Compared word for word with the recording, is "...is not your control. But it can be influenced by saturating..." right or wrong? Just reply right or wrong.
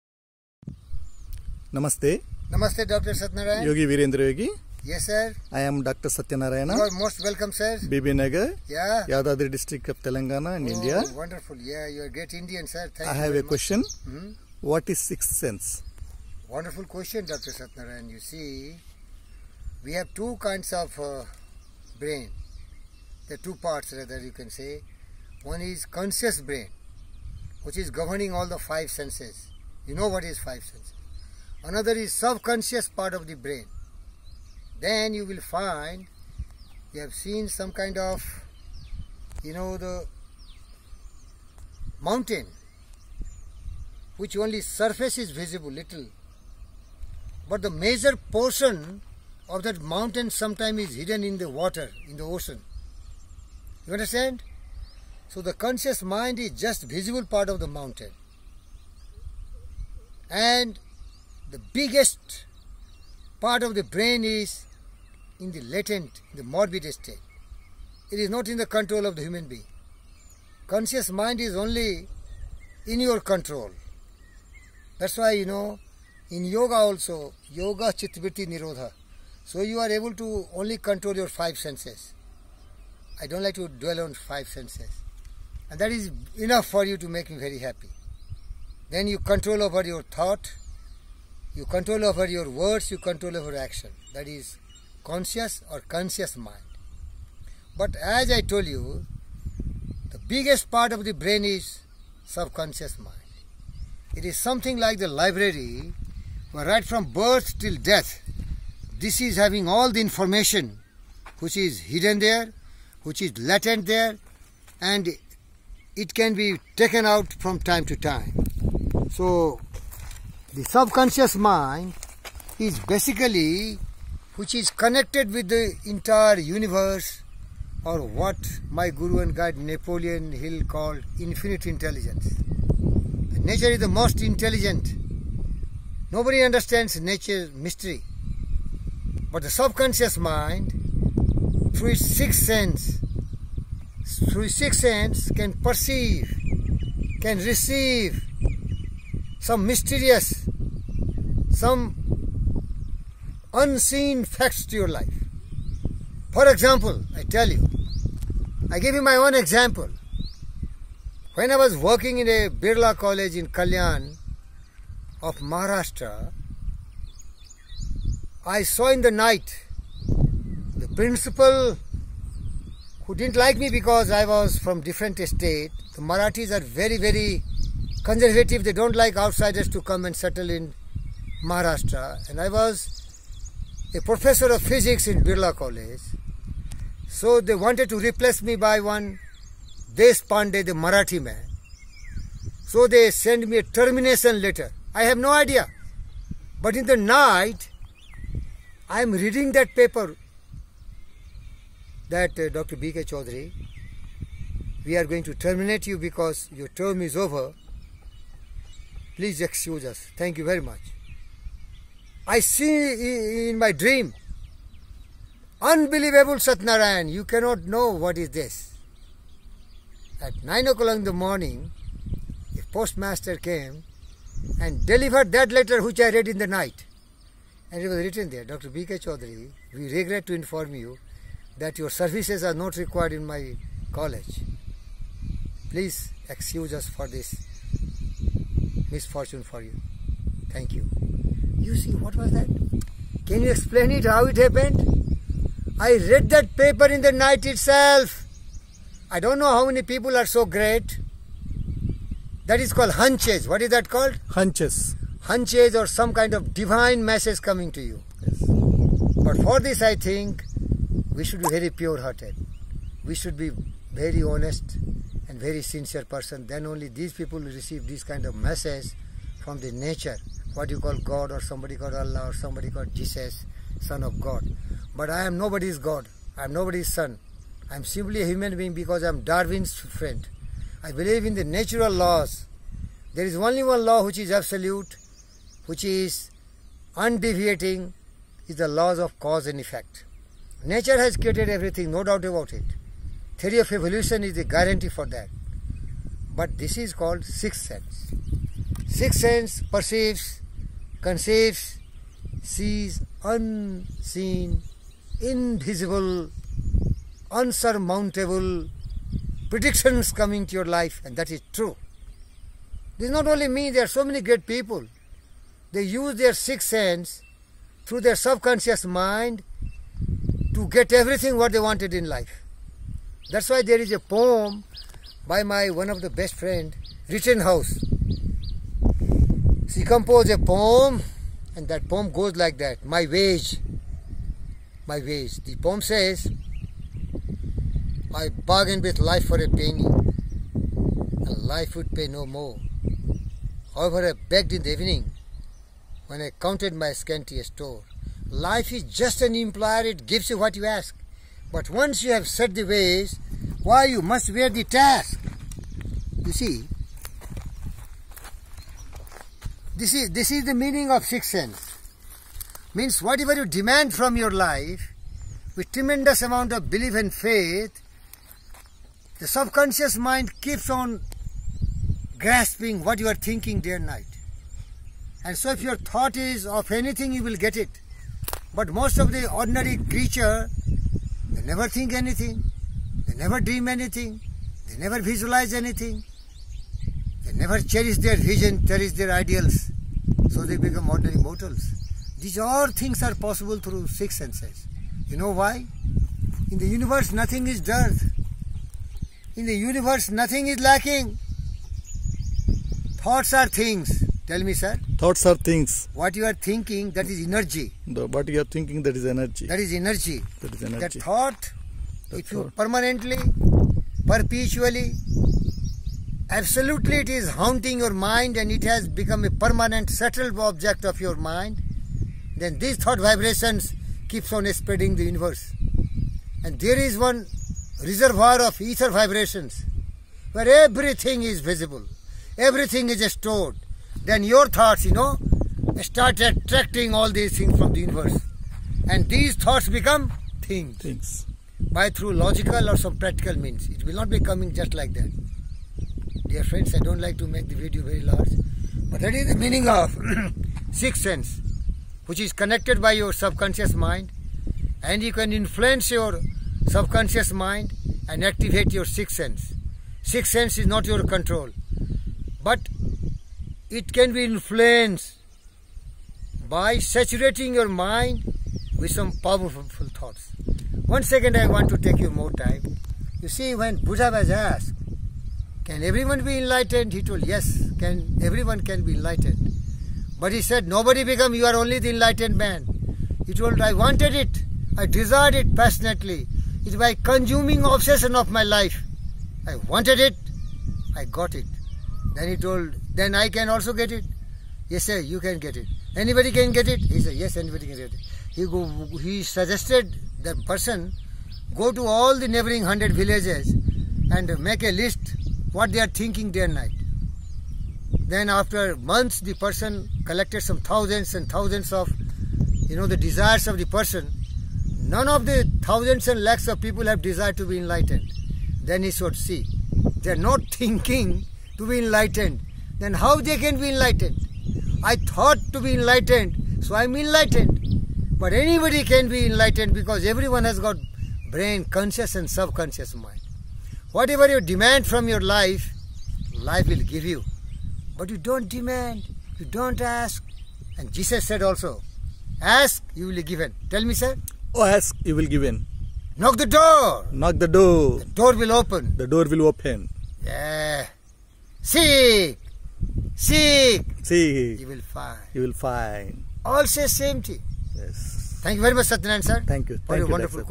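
right.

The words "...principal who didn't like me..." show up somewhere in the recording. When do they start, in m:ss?
2:50.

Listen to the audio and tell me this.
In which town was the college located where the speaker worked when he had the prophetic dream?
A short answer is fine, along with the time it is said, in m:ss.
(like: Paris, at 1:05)
Kalyan, at 2:43.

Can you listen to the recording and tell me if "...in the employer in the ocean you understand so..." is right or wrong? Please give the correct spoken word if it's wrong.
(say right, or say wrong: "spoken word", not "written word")
wrong: "water", not "employer".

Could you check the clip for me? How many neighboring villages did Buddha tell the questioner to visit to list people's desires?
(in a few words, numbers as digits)
100.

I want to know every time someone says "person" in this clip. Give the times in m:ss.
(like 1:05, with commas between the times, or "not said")
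4:26, 8:20, 8:29, 8:33.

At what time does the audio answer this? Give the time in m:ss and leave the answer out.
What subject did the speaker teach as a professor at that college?
3:04.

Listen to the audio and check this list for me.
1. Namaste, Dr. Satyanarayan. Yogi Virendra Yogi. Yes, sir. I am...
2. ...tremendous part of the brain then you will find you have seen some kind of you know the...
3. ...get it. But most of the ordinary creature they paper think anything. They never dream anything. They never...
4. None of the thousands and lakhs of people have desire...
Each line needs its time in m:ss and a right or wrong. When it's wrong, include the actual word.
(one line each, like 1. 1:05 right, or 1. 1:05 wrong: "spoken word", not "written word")
1. 0:02 right
2. 0:32 wrong: "subconscious", not "tremendous"
3. 6:17 wrong: "never", not "paper"
4. 8:34 right.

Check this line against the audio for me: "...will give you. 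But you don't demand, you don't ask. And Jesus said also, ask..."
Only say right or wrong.
right.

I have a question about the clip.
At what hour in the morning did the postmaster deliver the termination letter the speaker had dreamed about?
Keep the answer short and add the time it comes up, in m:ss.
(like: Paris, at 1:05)
9 o'clock, at 3:40.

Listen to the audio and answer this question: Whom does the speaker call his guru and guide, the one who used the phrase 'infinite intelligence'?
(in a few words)
Napoleon Hill.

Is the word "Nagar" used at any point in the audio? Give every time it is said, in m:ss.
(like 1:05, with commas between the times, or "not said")
0:08.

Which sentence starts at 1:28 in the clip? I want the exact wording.
Then you control over your thought, you control over your words, you control over action.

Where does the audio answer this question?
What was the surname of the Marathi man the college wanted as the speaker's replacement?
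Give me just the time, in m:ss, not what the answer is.
3:09.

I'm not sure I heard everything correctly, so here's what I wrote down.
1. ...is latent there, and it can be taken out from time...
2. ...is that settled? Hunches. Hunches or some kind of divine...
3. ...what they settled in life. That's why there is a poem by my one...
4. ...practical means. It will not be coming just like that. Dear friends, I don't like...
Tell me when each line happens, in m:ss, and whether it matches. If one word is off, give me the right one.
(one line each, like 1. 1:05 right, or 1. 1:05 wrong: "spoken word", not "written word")
1. 1:53 right
2. 4:13 wrong: "called", not "settled"
3. 5:21 wrong: "wanted", not "settled"
4. 7:22 right.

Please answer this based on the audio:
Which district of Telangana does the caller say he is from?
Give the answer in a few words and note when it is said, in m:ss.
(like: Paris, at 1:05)
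Yadadri, at 0:09.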